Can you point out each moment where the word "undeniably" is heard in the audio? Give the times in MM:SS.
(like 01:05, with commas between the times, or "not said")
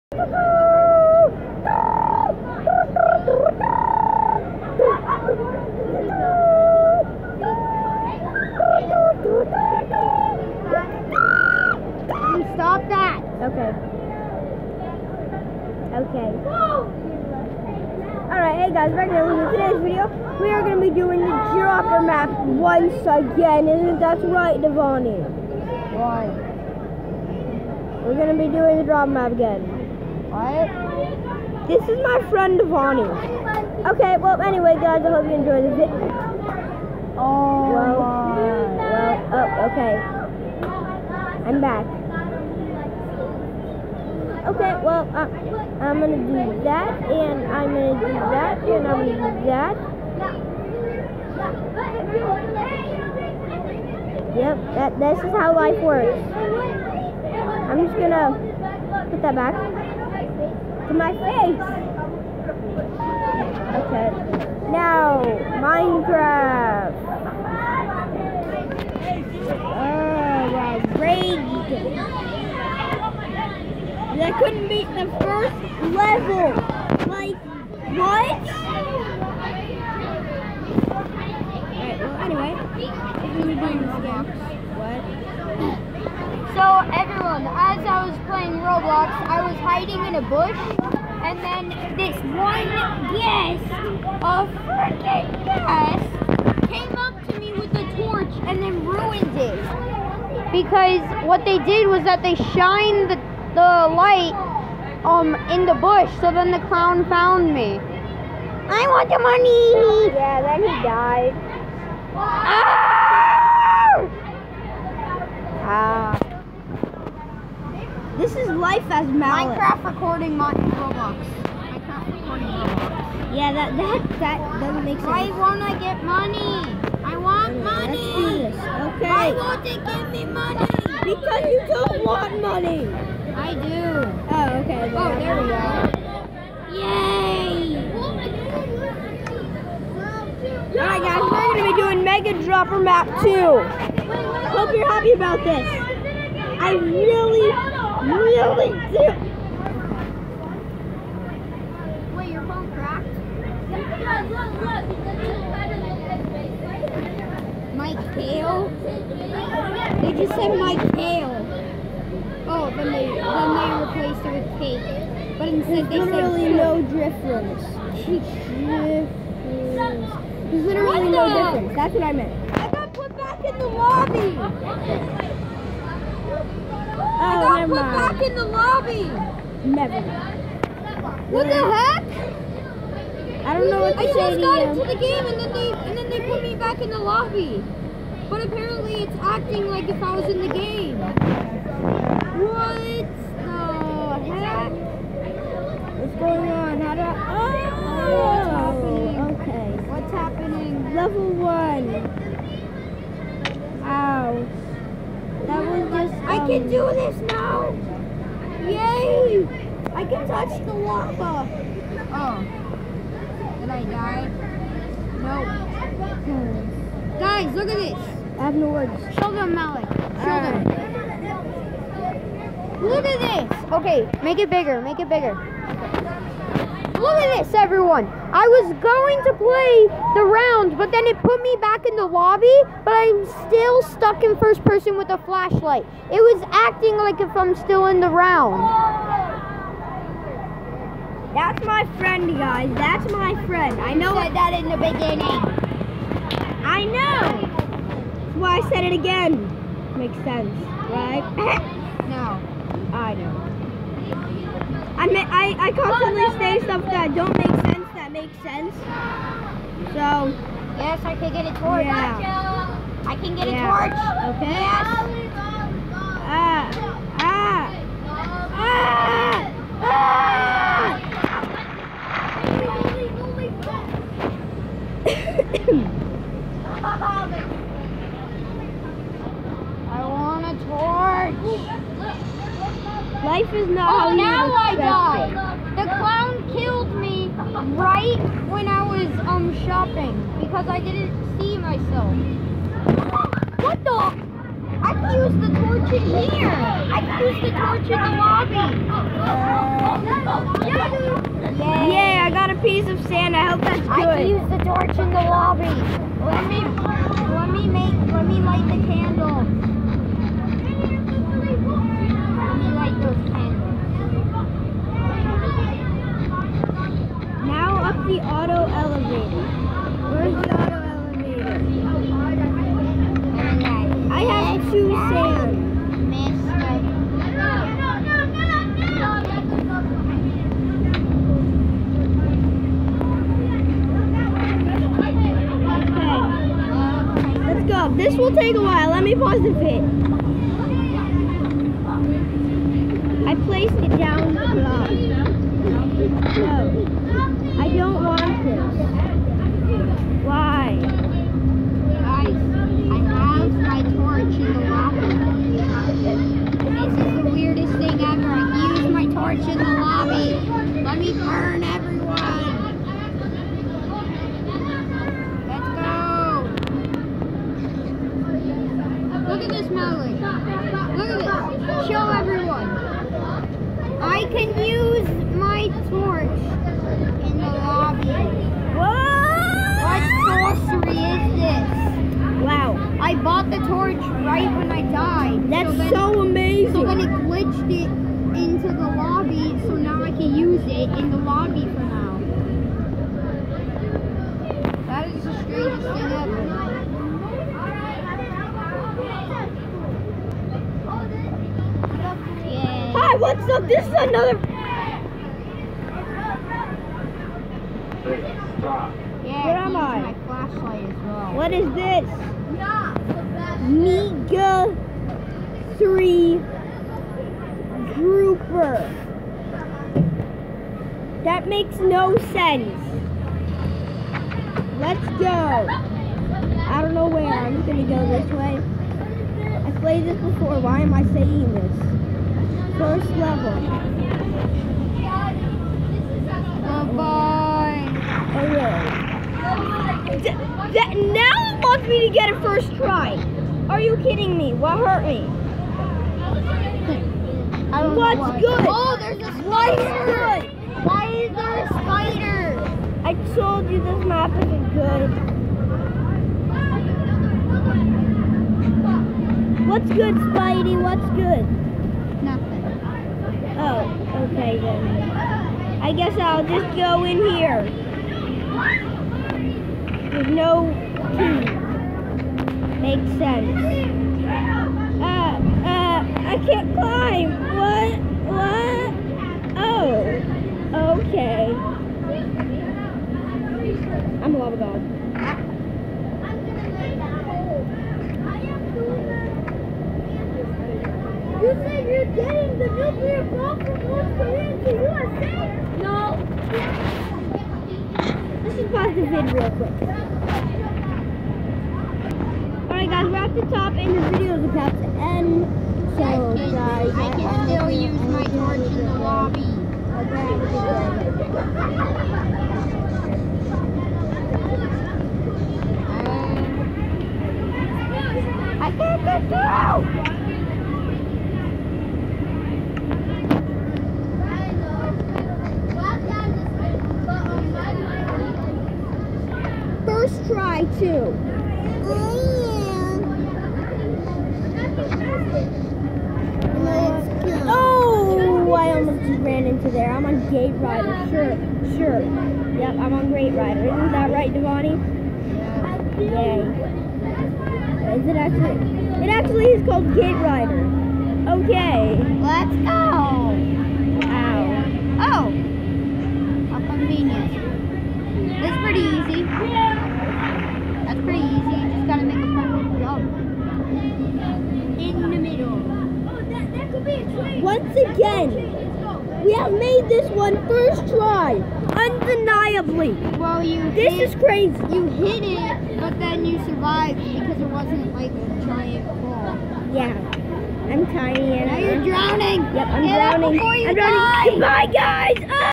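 09:31.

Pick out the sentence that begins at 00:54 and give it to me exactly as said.
Yep, that, this is how life works.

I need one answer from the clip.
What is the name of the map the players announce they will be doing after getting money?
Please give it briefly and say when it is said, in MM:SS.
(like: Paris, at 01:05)
Mega Dropper Map 2, at 02:22.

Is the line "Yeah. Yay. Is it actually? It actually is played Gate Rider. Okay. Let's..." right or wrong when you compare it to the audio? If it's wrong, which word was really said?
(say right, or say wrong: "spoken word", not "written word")
wrong: "called", not "played".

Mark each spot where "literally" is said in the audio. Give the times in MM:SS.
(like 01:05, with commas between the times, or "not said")
02:46, 02:50.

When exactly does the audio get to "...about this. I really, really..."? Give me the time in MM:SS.
02:25.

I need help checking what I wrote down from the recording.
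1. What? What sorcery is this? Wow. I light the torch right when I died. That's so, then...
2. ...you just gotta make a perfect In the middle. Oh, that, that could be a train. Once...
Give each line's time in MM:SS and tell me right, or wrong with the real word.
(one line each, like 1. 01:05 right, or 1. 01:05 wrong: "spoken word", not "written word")
1. 06:18 wrong: "bought", not "light"
2. 09:21 right.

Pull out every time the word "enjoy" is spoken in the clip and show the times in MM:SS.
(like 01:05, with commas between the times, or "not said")
00:35.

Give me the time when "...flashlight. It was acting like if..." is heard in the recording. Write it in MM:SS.
03:55.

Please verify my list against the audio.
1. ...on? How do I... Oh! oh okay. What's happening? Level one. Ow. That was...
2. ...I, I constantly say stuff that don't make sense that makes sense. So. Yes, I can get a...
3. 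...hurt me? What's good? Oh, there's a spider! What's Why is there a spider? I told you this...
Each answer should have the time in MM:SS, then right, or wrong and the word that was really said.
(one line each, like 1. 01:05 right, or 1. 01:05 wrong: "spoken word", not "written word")
1. 03:16 right
2. 04:15 right
3. 07:24 right.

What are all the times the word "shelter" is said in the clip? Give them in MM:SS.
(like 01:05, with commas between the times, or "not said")
not said.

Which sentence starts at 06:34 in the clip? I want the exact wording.
That is the strangest thing ever.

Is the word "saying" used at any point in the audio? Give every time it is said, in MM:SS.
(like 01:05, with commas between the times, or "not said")
07:11.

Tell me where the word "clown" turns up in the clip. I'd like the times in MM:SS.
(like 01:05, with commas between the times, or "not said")
01:46, 04:45.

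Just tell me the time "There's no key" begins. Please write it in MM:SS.
07:50.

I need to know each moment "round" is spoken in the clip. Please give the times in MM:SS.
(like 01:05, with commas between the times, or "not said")
03:50, 03:58.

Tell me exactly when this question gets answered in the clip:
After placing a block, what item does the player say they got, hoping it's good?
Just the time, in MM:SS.
05:02.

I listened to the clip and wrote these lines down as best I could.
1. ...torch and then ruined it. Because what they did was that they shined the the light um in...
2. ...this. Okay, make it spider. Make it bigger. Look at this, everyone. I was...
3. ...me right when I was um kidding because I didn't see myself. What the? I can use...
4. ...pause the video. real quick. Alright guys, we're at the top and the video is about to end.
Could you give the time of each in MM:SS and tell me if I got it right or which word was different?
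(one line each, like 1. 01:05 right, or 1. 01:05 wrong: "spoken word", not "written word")
1. 01:37 right
2. 03:43 wrong: "bigger", not "spider"
3. 04:46 wrong: "shopping", not "kidding"
4. 08:18 right.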